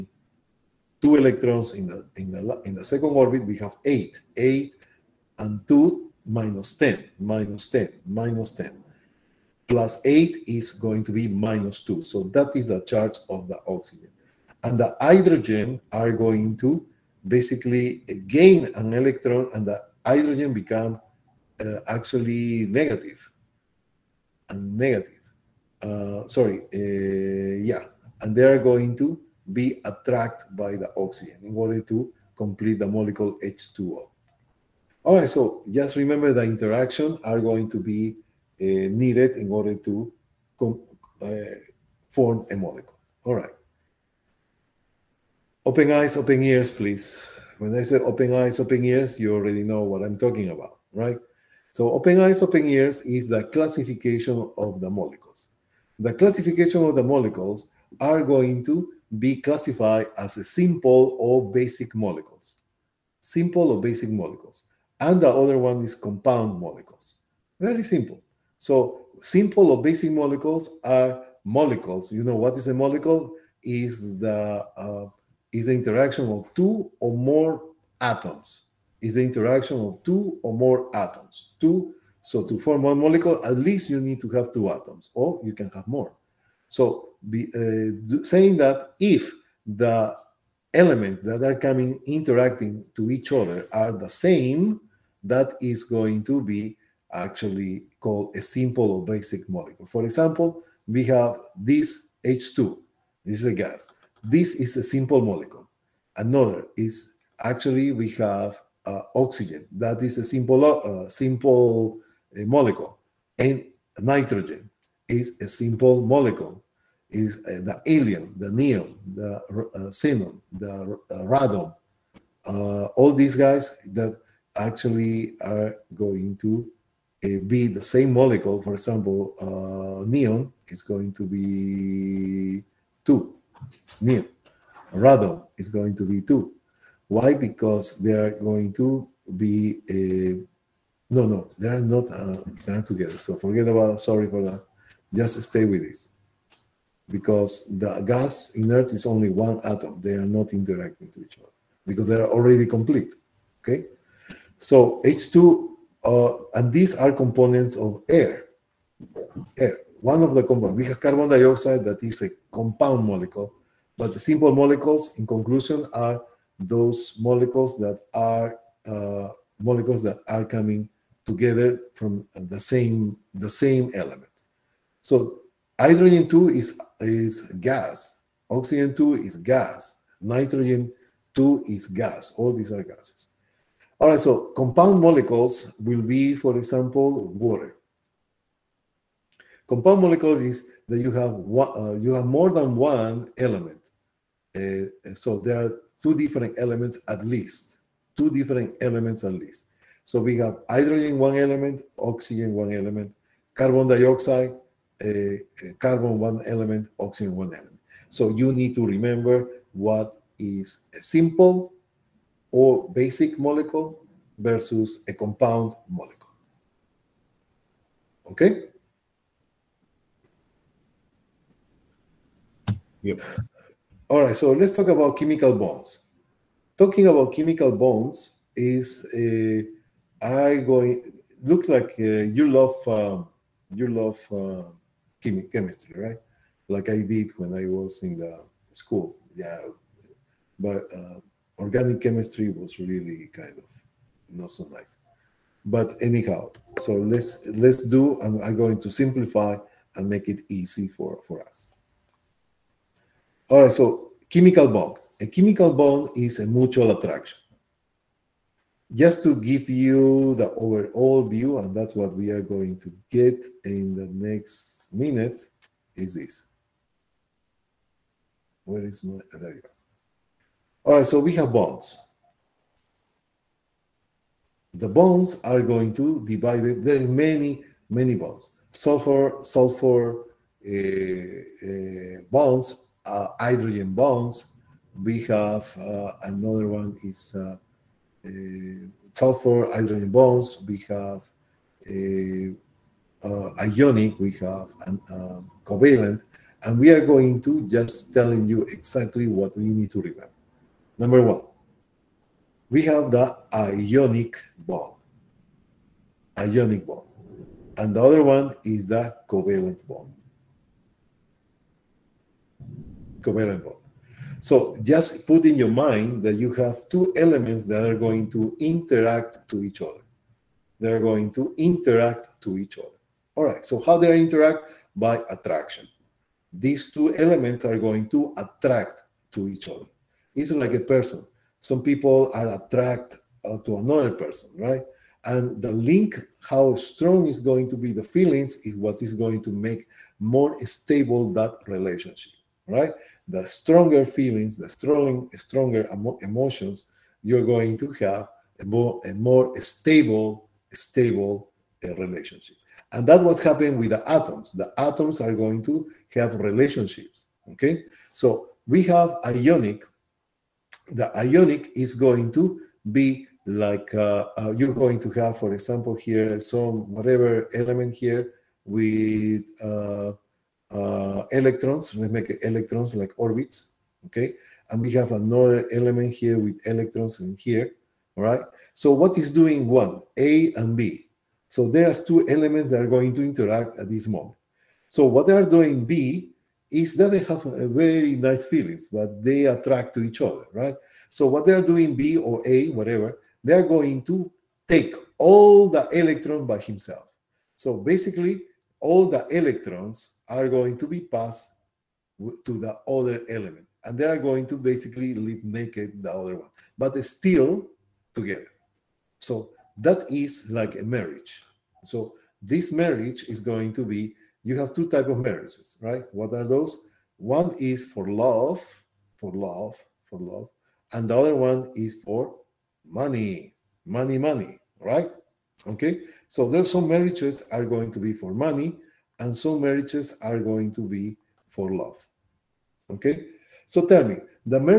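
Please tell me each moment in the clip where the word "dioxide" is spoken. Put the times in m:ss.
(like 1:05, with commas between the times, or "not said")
2:41, 3:23.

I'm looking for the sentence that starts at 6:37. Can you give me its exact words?
So basically, all the electrons are going to be passed to the other element.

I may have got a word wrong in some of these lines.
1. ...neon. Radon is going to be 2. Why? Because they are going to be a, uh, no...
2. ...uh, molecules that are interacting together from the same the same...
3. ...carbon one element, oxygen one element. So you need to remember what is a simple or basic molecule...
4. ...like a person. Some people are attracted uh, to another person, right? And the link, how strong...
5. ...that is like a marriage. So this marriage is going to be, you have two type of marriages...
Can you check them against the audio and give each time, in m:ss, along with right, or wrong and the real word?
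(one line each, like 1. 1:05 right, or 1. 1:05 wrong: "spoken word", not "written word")
1. 2:13 right
2. 2:48 wrong: "coming", not "interacting"
3. 3:25 right
4. 5:30 right
5. 6:49 right.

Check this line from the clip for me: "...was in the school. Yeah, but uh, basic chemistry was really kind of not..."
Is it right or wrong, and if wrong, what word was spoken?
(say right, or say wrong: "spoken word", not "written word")
wrong: "organic", not "basic".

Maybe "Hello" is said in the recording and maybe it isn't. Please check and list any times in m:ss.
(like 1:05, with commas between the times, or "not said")
not said.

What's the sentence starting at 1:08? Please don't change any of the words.
So simple or basic molecules are molecules.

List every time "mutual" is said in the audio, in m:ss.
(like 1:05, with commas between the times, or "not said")
4:16.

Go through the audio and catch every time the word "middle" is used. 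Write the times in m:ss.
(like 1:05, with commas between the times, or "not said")
not said.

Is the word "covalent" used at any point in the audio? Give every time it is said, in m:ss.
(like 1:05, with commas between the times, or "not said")
4:55, 5:09.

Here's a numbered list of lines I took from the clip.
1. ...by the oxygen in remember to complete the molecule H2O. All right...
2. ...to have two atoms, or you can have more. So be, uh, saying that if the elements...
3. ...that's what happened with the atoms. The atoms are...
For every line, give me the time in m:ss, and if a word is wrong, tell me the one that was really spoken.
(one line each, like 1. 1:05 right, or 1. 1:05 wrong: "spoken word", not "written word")
1. 0:30 wrong: "order", not "remember"
2. 1:24 right
3. 5:53 right.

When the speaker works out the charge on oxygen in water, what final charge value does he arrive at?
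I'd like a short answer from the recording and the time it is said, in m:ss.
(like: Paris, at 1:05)
-2, at 0:11.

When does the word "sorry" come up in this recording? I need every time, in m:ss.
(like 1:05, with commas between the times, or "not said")
0:26, 2:24.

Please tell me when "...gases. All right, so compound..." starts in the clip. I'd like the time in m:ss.
3:02.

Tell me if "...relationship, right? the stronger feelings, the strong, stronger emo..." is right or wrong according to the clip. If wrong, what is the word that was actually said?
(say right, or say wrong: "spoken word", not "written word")
right.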